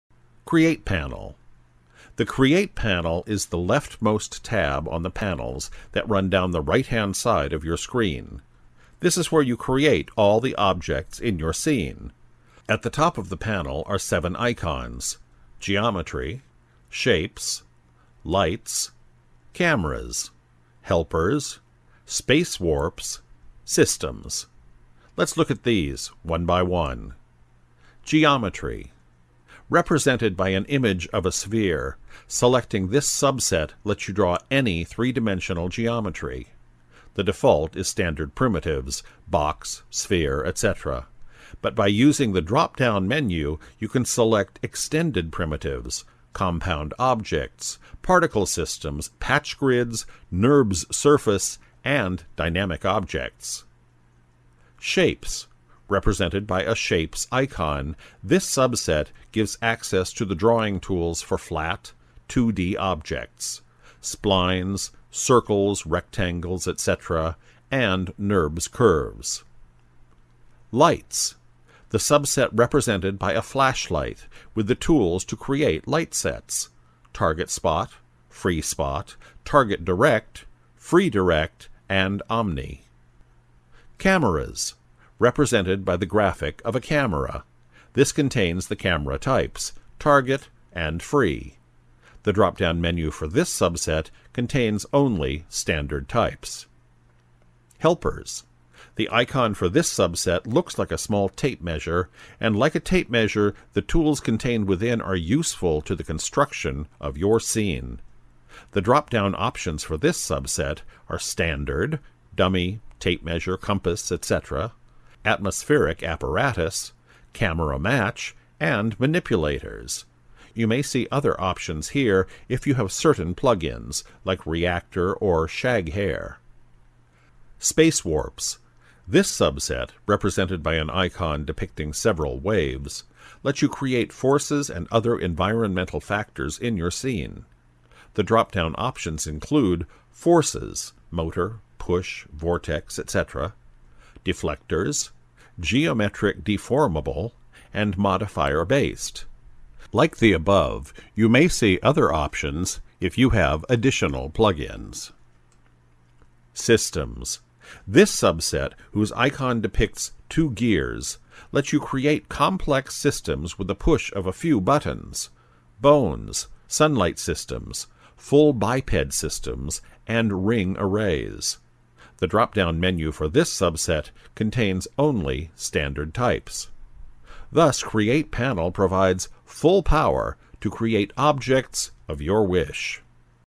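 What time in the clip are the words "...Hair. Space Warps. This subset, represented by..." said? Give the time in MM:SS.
02:05.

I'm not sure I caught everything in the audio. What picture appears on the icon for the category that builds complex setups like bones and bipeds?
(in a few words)
Two gears.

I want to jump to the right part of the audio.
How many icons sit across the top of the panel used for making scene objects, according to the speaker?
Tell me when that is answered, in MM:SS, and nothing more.
00:13.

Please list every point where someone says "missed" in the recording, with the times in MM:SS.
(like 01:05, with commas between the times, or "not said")
not said.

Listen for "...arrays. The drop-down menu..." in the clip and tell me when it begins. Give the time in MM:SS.
02:50.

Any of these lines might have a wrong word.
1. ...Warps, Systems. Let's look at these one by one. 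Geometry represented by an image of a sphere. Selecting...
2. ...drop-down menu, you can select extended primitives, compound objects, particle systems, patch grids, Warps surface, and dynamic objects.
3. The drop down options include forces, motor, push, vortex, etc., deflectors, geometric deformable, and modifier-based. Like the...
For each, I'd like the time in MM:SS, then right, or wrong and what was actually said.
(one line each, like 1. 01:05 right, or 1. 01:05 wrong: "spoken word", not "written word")
1. 00:22 right
2. 00:42 wrong: "NURBS", not "Warps"
3. 02:18 right.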